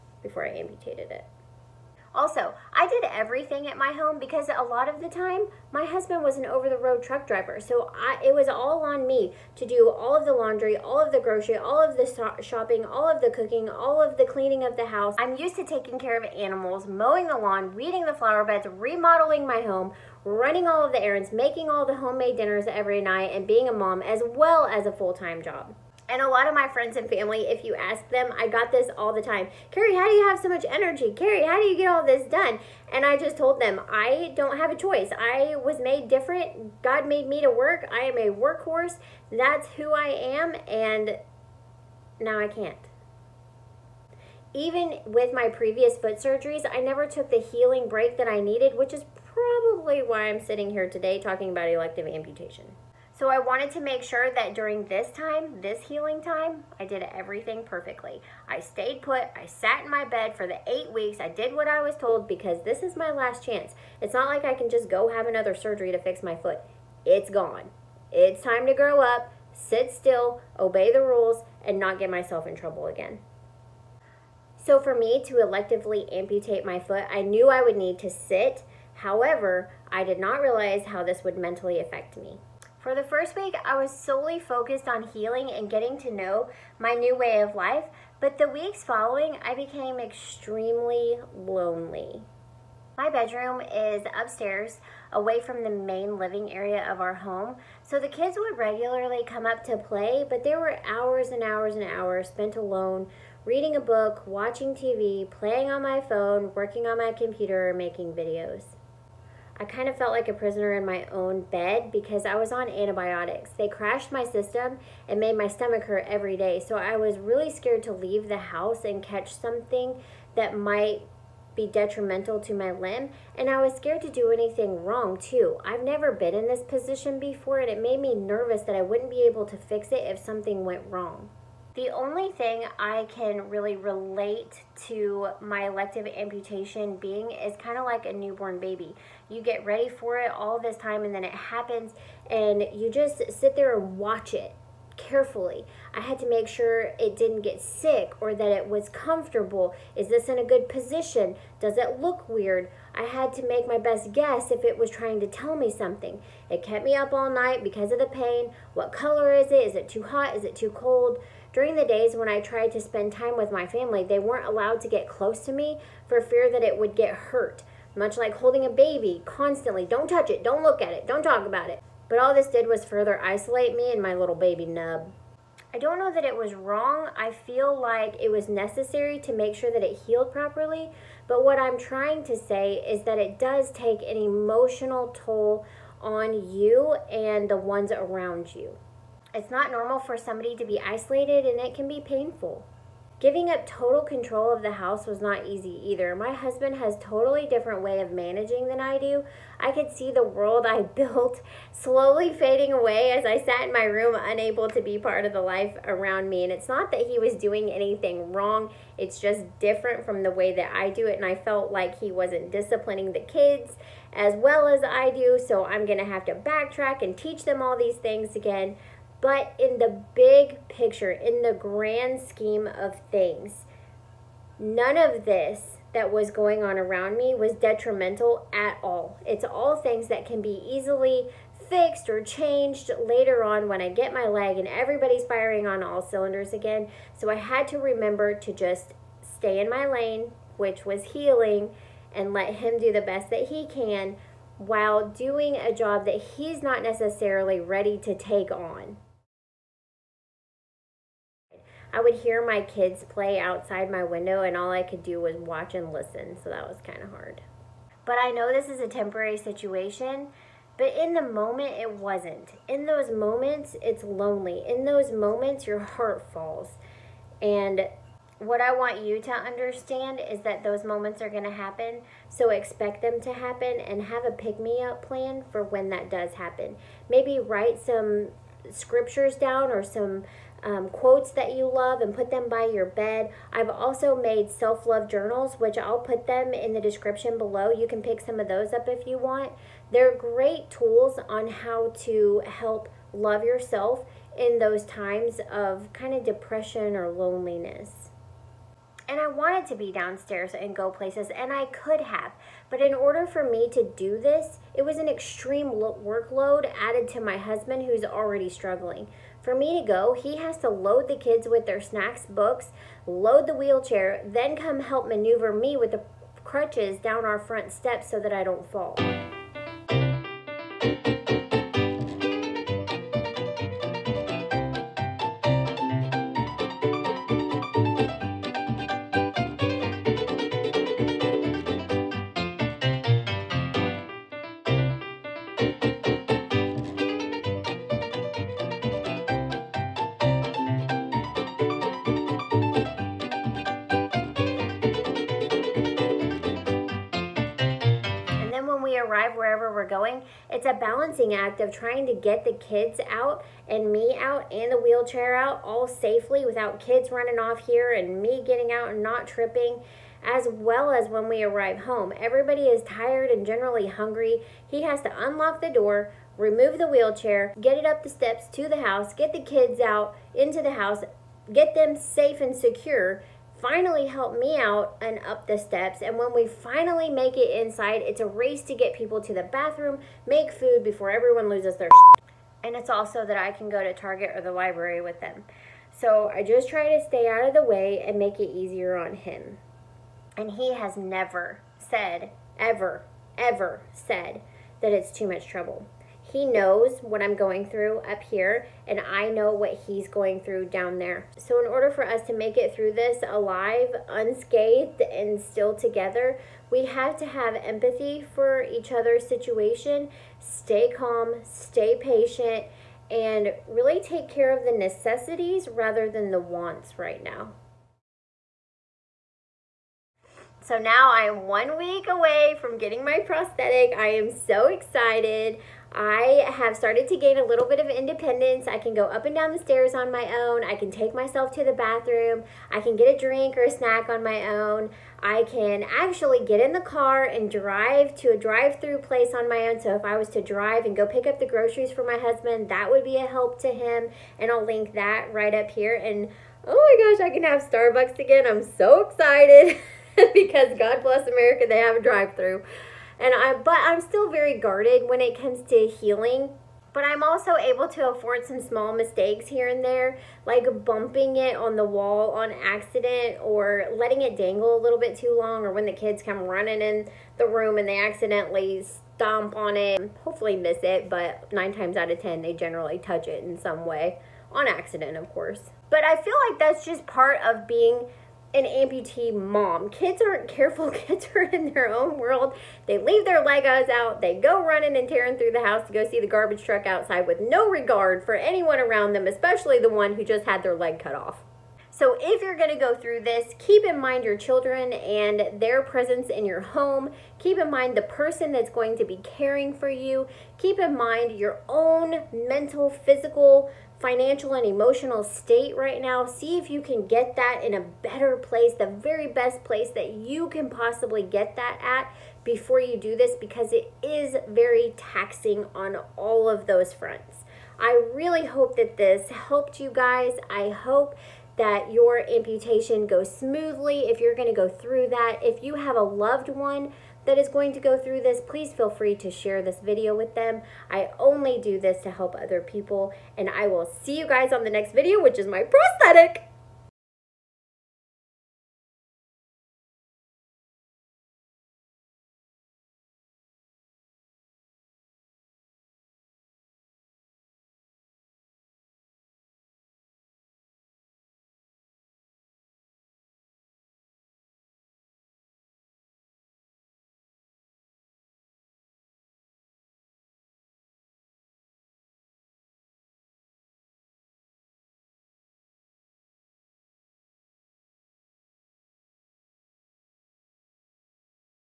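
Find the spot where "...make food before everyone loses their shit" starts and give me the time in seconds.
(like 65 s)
380 s.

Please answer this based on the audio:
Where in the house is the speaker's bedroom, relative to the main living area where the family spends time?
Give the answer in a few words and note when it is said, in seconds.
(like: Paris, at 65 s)
Upstairs, at 94 s.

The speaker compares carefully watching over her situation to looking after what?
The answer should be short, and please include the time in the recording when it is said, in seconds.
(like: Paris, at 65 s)
A newborn baby, at 138 s.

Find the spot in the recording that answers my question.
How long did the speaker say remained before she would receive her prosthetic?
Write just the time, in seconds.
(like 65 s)
421 s.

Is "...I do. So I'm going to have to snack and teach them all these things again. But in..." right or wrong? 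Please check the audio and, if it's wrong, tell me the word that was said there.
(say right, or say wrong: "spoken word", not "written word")
wrong: "backtrack", not "snack".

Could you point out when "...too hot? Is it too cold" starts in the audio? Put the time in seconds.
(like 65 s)
159 s.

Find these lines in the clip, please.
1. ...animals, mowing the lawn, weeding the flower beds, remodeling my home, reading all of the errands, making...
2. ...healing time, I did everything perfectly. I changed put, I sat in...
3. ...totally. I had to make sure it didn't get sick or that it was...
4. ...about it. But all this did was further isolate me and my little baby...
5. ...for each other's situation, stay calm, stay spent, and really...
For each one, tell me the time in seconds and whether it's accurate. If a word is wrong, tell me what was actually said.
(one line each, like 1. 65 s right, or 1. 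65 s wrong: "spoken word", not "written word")
1. 16 s wrong: "running", not "reading"
2. 55 s wrong: "stayed", not "changed"
3. 144 s wrong: "carefully", not "totally"
4. 171 s right
5. 408 s wrong: "patient", not "spent".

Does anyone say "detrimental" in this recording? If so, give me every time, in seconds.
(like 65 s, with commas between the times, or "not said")
121 s, 227 s.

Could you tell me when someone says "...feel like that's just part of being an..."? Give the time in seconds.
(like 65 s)
476 s.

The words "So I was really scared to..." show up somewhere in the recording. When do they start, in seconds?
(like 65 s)
116 s.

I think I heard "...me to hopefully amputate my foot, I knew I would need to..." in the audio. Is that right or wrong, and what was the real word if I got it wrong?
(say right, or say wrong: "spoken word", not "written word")
wrong: "electively", not "hopefully".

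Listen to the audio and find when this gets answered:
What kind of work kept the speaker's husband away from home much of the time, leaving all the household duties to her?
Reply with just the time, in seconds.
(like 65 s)
6 s.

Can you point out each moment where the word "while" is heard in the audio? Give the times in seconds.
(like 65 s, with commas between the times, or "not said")
244 s.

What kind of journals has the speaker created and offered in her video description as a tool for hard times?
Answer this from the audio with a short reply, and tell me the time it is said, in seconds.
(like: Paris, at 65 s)
Self love journals, at 284 s.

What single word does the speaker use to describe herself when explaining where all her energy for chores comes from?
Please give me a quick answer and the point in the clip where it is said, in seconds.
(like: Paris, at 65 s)
Workhorse, at 38 s.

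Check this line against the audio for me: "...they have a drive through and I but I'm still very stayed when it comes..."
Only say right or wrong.
wrong.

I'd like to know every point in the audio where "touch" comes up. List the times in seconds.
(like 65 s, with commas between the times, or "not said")
170 s, 472 s.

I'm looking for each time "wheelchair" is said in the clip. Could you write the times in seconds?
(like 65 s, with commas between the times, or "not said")
313 s, 354 s, 366 s.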